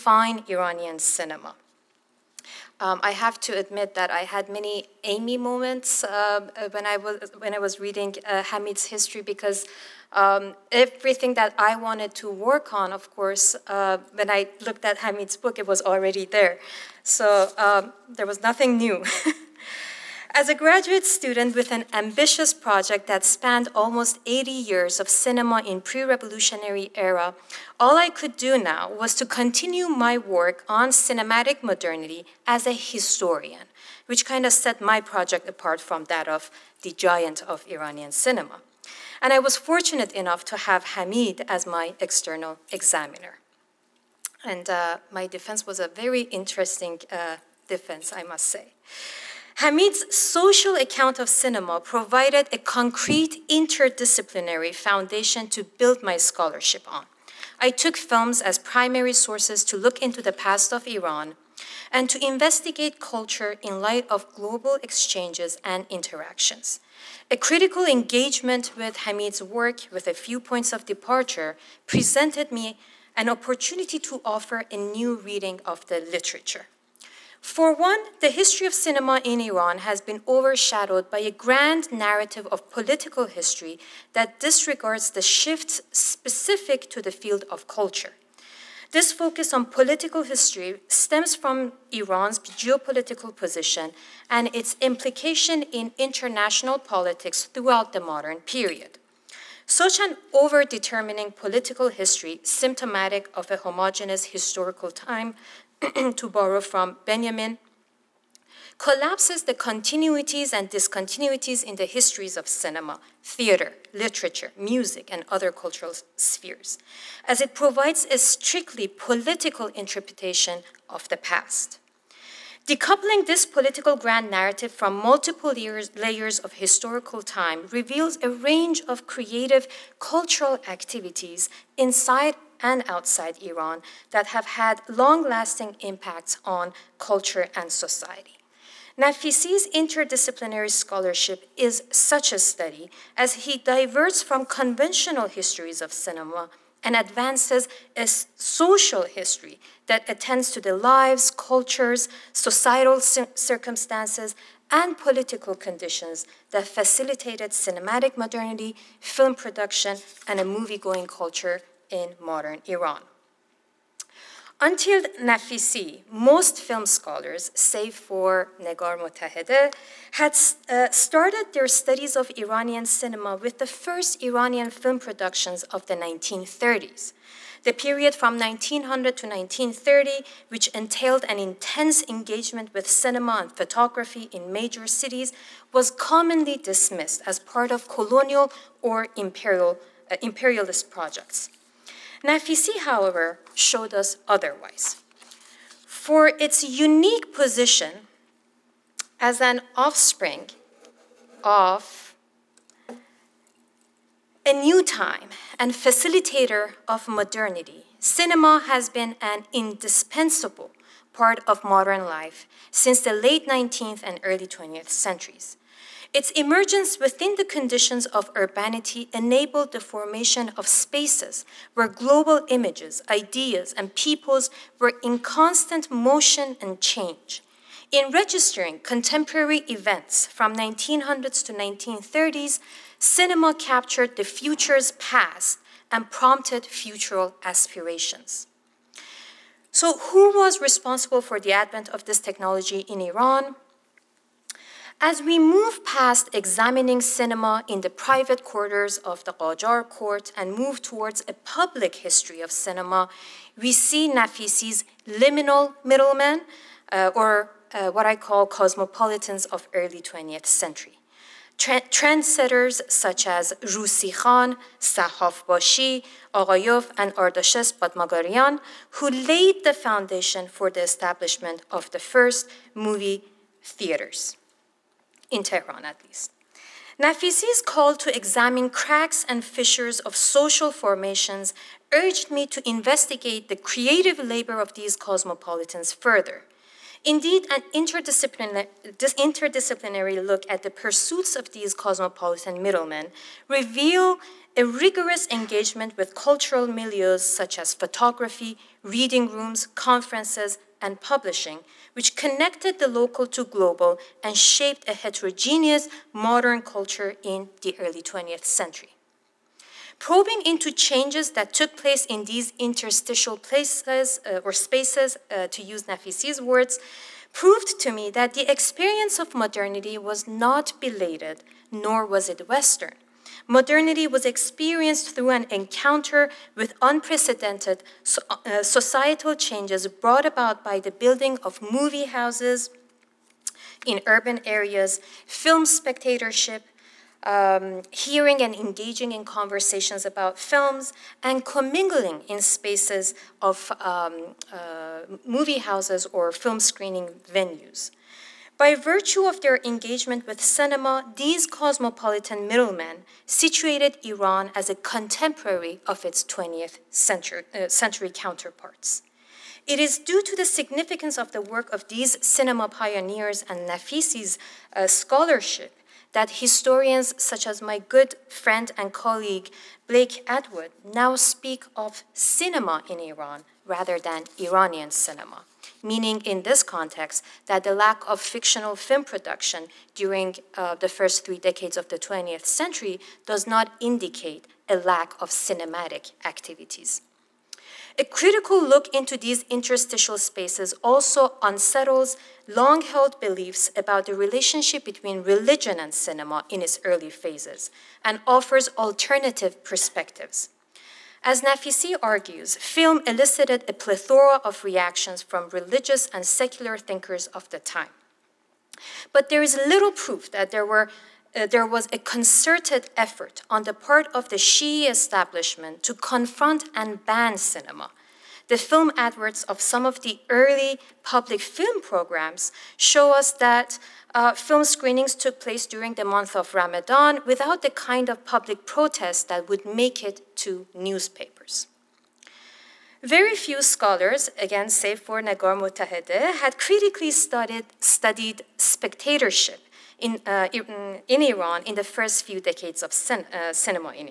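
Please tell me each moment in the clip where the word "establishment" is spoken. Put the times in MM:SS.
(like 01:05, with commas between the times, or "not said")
04:30, 06:54.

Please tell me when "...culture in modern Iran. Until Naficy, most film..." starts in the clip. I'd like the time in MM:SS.
02:41.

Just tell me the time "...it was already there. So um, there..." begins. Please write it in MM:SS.
00:15.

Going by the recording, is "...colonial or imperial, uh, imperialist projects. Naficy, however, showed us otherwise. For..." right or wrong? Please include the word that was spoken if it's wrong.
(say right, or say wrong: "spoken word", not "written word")
right.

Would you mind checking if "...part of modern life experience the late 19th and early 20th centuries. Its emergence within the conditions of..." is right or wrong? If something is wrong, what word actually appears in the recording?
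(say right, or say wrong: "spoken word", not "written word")
wrong: "since", not "experience".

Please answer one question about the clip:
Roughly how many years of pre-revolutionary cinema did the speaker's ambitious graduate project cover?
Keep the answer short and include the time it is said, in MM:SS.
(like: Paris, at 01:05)
80, at 00:24.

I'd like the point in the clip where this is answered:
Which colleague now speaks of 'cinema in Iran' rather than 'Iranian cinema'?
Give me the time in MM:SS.
06:09.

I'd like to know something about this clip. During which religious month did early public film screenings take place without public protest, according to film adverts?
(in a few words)
Ramadan.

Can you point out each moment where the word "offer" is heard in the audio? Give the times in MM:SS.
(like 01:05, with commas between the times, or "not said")
01:14, 06:38.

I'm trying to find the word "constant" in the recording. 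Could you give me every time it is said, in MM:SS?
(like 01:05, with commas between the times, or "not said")
03:45.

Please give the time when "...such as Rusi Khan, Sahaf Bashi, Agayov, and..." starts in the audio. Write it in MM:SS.
04:22.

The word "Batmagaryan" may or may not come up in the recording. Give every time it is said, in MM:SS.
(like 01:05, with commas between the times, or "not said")
04:27.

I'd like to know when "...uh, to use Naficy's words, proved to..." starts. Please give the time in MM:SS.
05:15.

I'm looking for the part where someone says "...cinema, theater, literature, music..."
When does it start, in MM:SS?
01:52.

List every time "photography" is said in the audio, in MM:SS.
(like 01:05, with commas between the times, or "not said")
03:03, 04:57.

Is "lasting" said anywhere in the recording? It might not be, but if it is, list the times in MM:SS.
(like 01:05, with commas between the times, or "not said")
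02:15.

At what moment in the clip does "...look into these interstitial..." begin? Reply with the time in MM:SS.
06:28.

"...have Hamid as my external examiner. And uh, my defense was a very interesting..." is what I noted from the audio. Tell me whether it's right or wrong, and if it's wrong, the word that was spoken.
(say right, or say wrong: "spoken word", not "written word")
right.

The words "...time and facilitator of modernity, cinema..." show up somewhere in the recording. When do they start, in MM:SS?
03:24.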